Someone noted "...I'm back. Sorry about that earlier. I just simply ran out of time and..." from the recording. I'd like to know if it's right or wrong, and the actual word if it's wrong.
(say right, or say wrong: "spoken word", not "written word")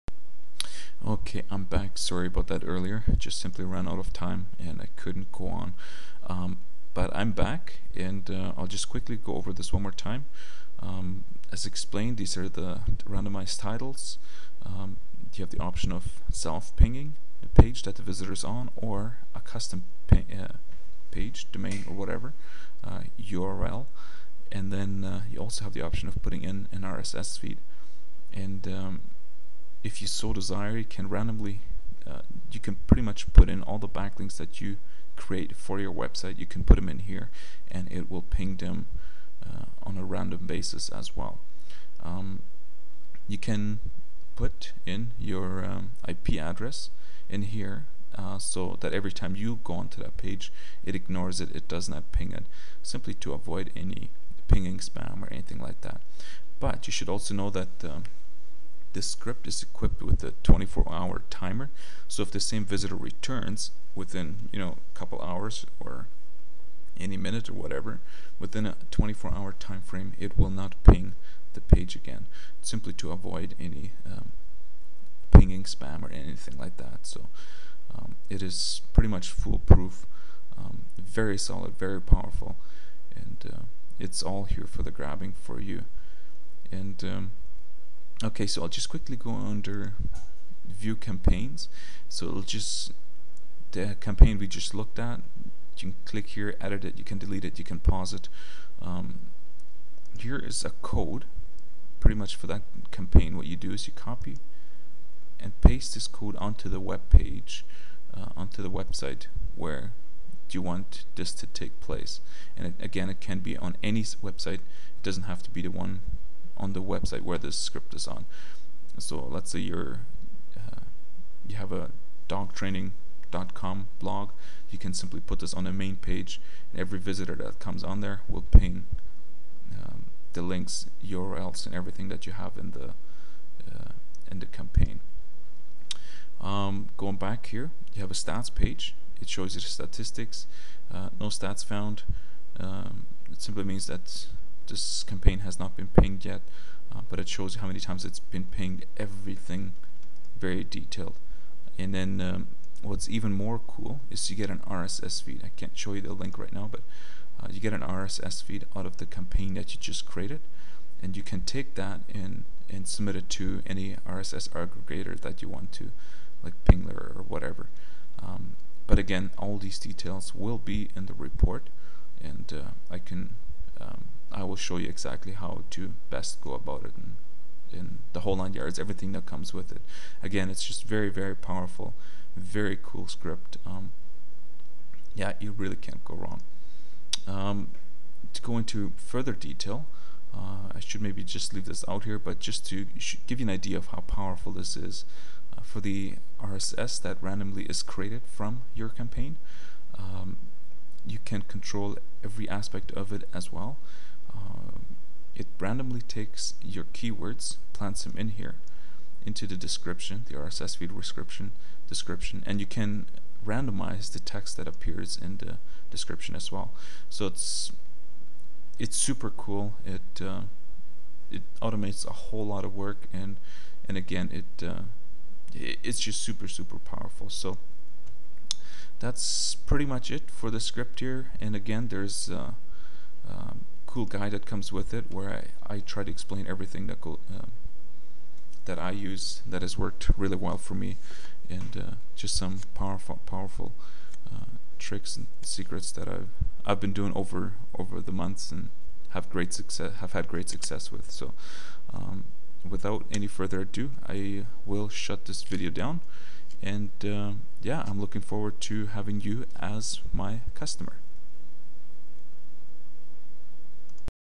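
right.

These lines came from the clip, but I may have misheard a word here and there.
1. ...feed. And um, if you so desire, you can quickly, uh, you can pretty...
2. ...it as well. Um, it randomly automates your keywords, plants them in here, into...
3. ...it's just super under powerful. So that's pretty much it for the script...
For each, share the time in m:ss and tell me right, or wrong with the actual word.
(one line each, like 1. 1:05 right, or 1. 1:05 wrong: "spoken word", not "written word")
1. 0:27 wrong: "randomly", not "quickly"
2. 3:23 wrong: "takes", not "automates"
3. 3:45 wrong: "super", not "under".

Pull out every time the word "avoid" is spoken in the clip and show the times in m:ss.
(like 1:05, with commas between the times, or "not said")
0:53, 1:13.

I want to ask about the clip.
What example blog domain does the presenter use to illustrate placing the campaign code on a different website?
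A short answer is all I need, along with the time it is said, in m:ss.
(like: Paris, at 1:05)
dogtraining.com, at 2:02.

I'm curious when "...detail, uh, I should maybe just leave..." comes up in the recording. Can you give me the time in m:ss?
3:09.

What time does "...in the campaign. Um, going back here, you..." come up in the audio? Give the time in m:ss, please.
2:14.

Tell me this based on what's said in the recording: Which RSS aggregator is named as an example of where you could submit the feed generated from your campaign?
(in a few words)
Pingler.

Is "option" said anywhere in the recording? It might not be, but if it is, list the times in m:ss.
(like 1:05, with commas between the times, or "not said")
0:15, 0:25.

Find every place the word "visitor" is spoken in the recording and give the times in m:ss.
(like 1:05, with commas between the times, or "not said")
0:18, 1:02, 2:06.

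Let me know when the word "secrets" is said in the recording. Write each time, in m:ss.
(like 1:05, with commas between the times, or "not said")
4:05.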